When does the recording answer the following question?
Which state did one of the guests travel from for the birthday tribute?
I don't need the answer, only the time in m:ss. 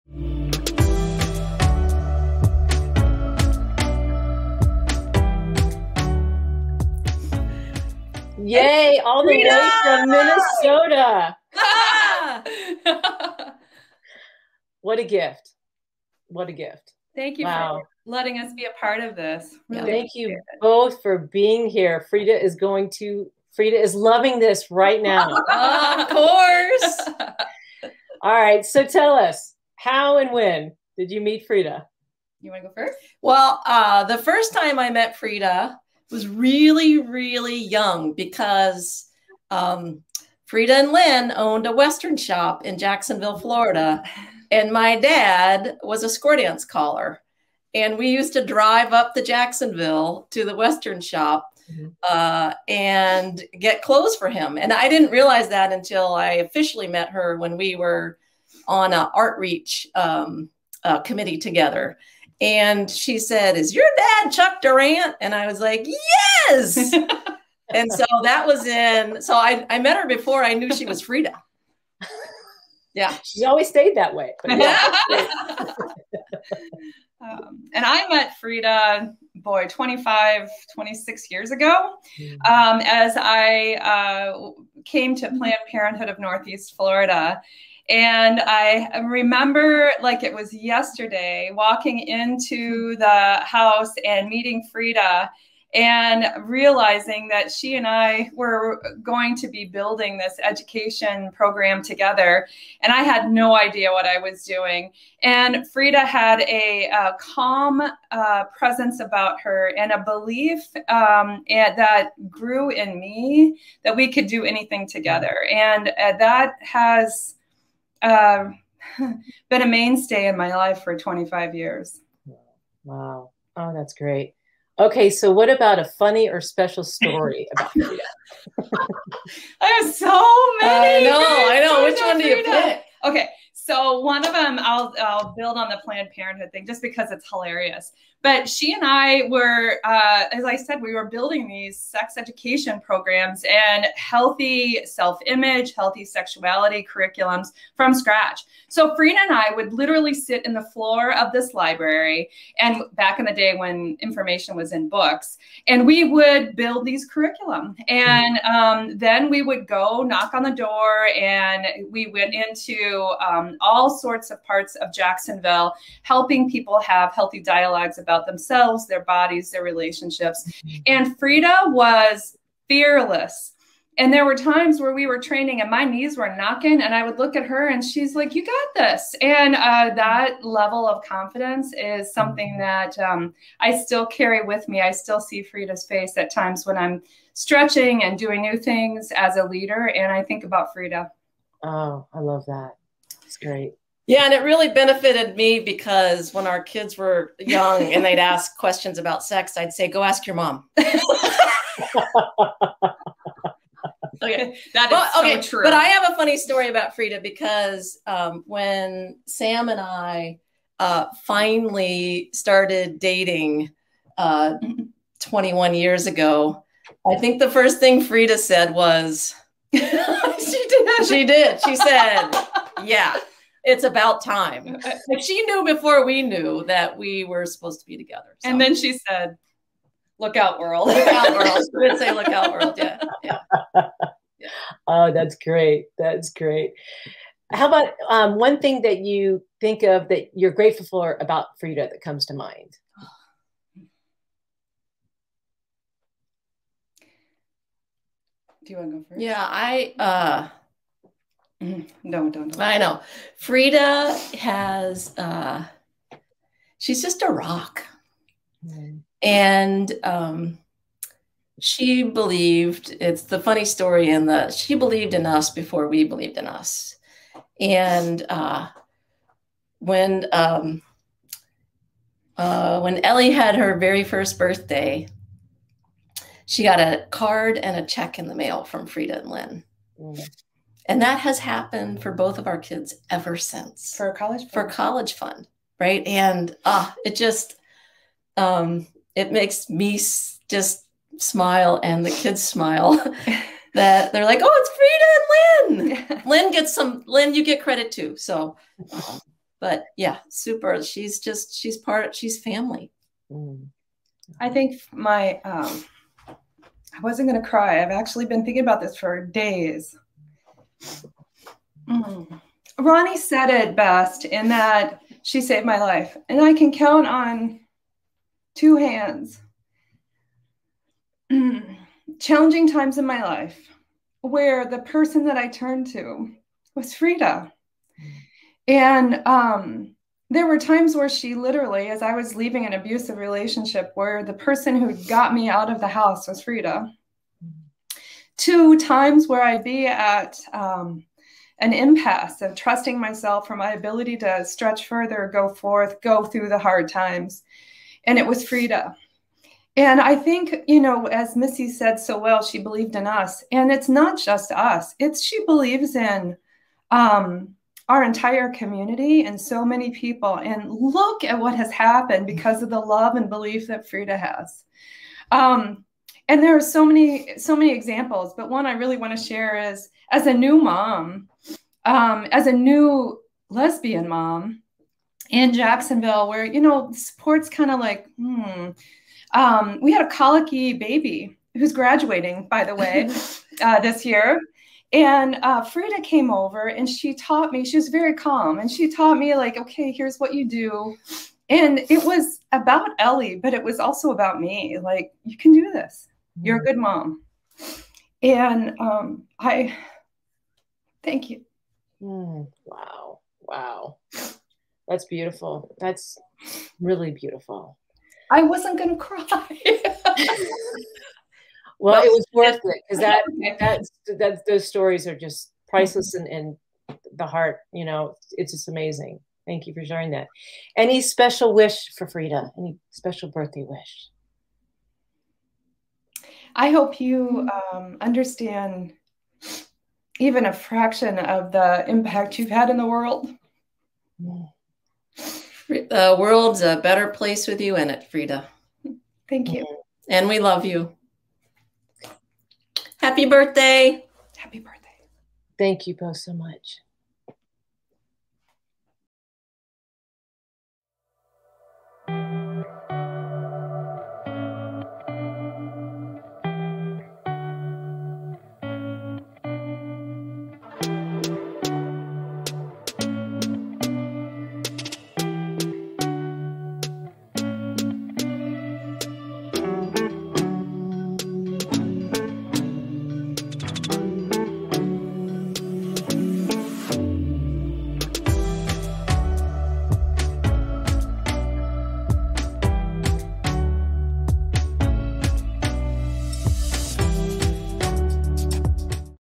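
0:10.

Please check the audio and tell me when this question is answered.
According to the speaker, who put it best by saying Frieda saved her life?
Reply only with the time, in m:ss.
5:12.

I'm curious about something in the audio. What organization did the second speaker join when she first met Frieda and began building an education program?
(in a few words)
Planned Parenthood of Northeast Florida.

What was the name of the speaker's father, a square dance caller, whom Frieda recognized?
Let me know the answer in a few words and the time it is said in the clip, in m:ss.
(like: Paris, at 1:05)
Chuck Durant, at 1:04.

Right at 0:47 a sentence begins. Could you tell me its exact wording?
And we used to drive up to Jacksonville to the Western shop mm-hmm.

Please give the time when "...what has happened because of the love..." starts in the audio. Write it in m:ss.
6:01.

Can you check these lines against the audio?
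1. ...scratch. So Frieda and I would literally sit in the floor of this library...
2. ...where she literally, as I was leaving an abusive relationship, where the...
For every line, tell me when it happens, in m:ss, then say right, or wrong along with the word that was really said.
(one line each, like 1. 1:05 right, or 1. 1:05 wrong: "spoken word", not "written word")
1. 2:27 right
2. 5:30 right.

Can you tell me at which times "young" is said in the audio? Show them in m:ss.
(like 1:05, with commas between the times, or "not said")
0:37, 3:17.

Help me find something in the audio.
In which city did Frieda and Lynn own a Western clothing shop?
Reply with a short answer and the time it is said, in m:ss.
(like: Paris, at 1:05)
Jacksonville, Florida, at 0:42.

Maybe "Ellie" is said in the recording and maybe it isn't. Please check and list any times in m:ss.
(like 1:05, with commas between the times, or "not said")
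4:33, 6:32.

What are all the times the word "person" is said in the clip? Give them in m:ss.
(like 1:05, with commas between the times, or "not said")
5:24, 5:34.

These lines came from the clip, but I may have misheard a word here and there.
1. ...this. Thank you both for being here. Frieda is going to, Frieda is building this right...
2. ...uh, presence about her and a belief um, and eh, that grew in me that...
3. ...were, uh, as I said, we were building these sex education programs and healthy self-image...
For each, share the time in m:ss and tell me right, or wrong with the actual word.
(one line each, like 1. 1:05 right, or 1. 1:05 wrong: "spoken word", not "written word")
1. 0:19 wrong: "loving", not "building"
2. 1:48 right
3. 2:19 right.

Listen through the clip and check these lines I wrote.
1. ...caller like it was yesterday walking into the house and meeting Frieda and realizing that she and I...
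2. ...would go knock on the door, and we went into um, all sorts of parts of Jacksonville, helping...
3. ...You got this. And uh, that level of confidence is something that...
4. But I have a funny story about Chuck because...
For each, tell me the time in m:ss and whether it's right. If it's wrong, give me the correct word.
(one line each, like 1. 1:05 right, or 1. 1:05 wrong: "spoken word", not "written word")
1. 1:29 wrong: "remember", not "caller"
2. 2:39 right
3. 2:58 right
4. 3:25 wrong: "Frieda", not "Chuck".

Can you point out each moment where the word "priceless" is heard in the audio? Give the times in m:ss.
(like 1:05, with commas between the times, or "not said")
6:55.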